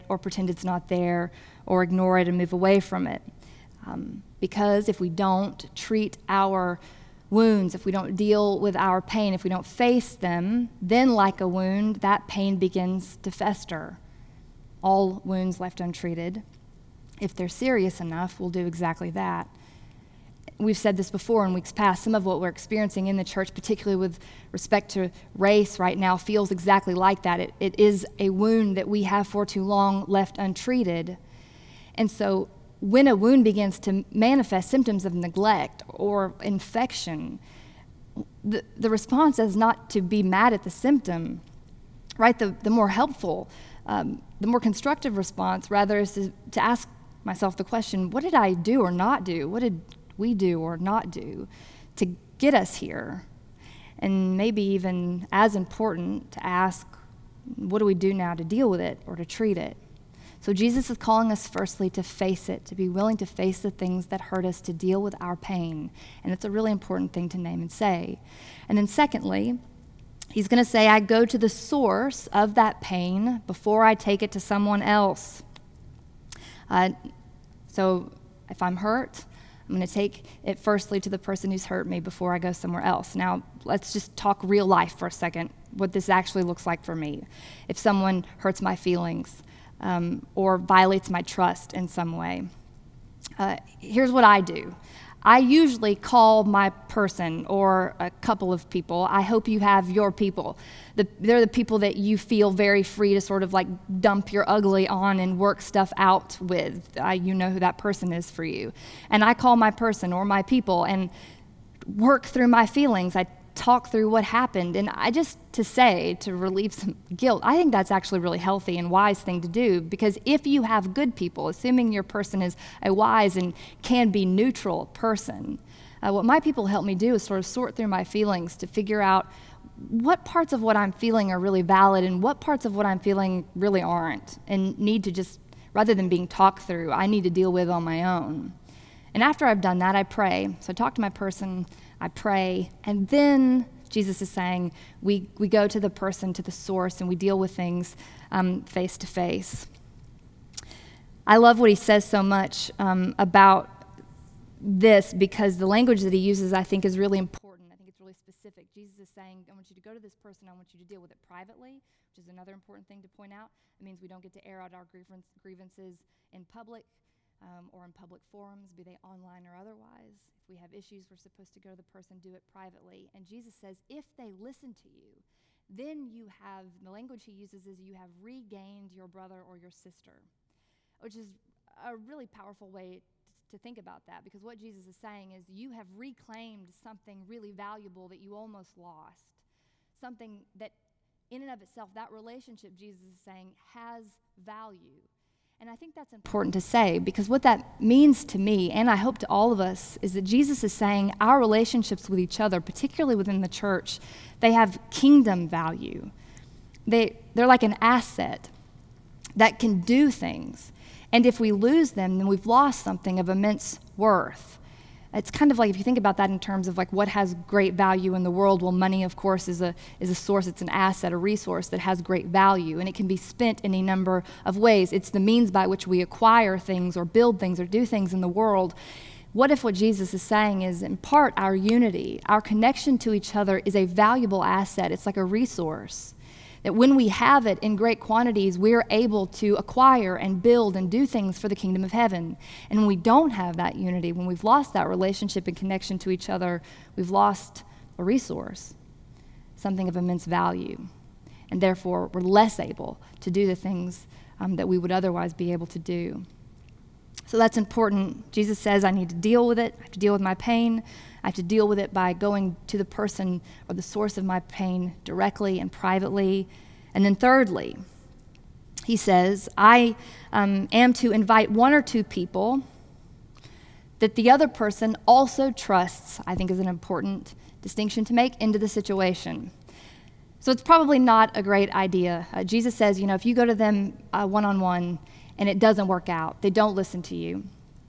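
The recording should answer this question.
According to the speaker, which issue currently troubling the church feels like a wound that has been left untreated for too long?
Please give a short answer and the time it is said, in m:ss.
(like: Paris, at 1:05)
Race, at 0:25.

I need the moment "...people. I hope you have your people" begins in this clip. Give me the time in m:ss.
1:38.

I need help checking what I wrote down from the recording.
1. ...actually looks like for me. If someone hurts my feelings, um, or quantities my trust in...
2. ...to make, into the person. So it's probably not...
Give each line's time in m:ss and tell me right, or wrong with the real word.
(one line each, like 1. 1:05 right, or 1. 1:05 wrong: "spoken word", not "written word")
1. 1:26 wrong: "violates", not "quantities"
2. 4:38 wrong: "situation", not "person".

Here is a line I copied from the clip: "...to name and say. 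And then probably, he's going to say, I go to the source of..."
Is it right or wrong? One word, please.
wrong.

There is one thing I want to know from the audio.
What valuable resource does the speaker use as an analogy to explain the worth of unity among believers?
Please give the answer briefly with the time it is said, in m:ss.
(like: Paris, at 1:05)
Money, at 3:38.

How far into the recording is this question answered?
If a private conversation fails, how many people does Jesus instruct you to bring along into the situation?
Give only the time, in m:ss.
4:31.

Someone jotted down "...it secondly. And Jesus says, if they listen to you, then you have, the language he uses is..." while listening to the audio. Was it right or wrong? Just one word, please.
wrong.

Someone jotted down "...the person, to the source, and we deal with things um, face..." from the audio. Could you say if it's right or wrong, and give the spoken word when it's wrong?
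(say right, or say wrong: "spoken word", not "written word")
right.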